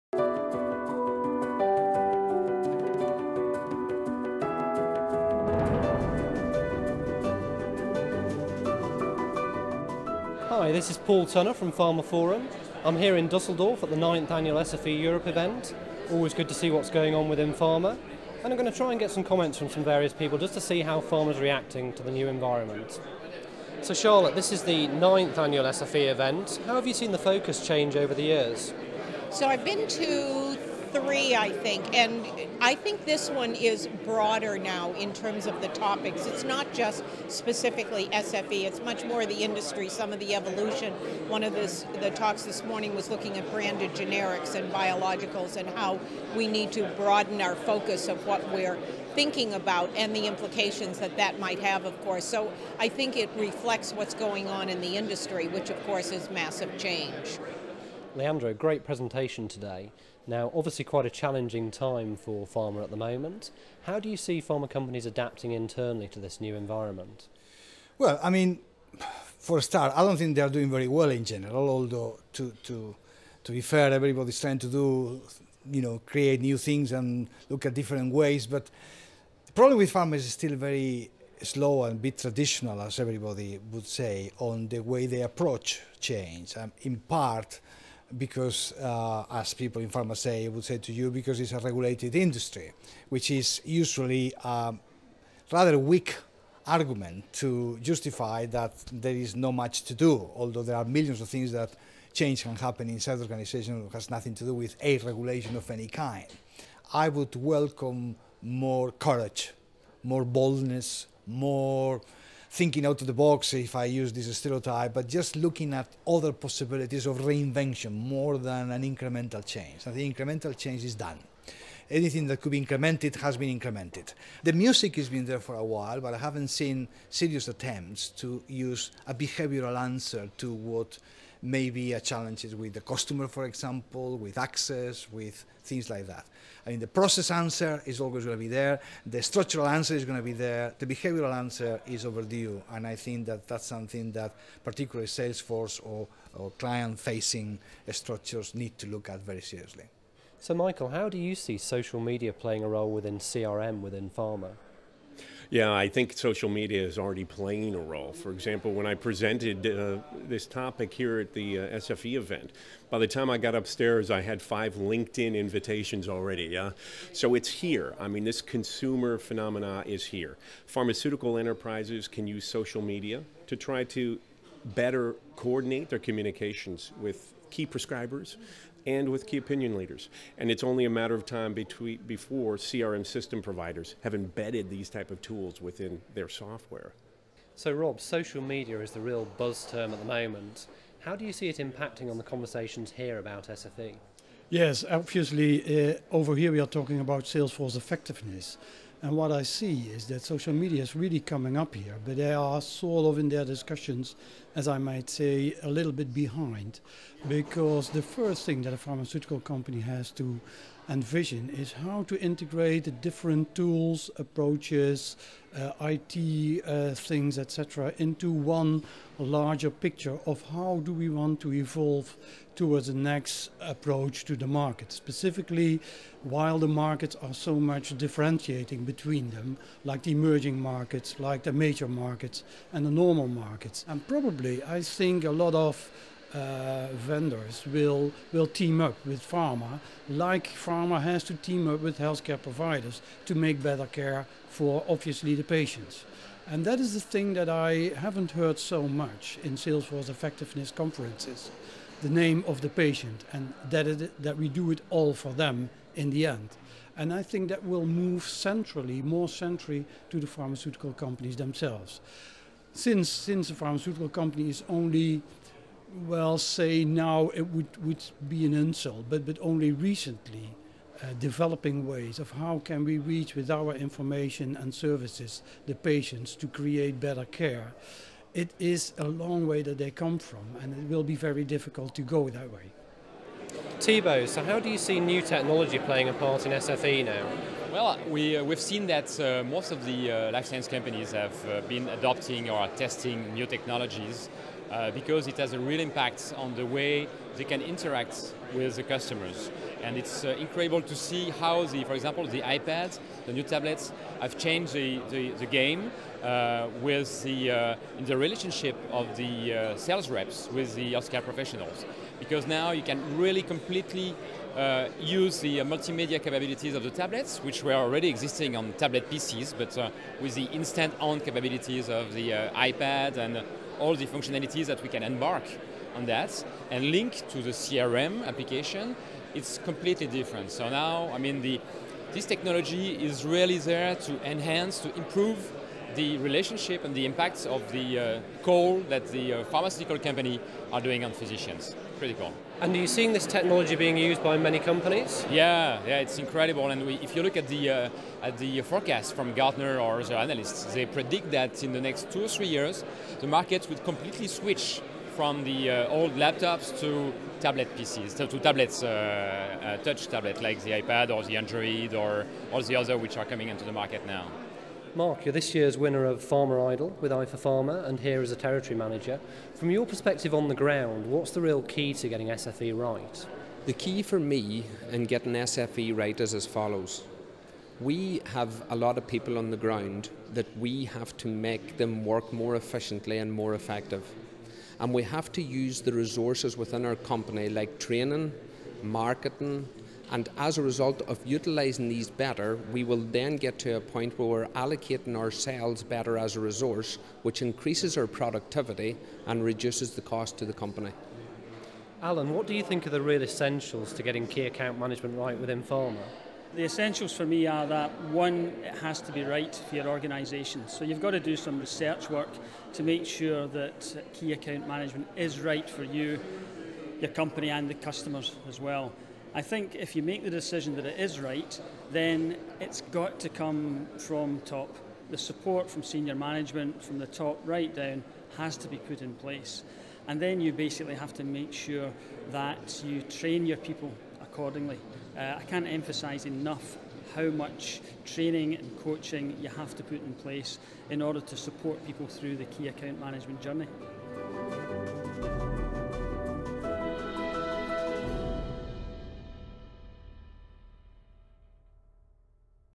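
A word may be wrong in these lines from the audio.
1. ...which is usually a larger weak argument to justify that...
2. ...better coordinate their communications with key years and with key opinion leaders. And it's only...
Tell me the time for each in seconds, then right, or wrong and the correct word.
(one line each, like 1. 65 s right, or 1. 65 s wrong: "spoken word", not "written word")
1. 93 s wrong: "rather", not "larger"
2. 174 s wrong: "prescribers", not "years".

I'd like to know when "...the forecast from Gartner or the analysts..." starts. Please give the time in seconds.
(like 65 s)
348 s.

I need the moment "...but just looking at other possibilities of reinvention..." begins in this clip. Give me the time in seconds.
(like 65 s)
114 s.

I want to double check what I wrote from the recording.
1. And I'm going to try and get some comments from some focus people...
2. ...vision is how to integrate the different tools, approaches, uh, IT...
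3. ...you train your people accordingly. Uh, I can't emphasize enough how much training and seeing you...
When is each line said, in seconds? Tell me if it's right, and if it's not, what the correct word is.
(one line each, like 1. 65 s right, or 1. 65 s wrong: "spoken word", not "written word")
1. 18 s wrong: "various", not "focus"
2. 211 s right
3. 432 s wrong: "coaching", not "seeing".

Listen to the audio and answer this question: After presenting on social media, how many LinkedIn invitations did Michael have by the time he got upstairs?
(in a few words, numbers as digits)
5.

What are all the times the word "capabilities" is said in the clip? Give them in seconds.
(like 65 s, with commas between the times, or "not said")
316 s, 321 s.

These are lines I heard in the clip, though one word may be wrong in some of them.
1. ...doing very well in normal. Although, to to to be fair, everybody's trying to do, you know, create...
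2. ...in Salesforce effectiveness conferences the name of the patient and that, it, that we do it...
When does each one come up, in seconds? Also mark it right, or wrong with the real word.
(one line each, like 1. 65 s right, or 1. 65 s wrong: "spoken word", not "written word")
1. 70 s wrong: "general", not "normal"
2. 249 s right.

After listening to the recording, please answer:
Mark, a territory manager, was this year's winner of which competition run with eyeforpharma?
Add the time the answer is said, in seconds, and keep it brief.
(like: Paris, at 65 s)
Pharma Idol, at 366 s.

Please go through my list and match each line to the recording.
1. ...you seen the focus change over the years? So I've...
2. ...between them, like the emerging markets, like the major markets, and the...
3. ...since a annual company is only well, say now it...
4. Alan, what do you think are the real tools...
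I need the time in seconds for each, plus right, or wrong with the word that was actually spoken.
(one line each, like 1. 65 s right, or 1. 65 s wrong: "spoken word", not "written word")
1. 26 s right
2. 228 s right
3. 263 s wrong: "pharmaceutical", not "annual"
4. 402 s wrong: "essentials", not "tools".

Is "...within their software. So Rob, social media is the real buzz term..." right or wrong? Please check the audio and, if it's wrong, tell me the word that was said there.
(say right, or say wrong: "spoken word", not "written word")
right.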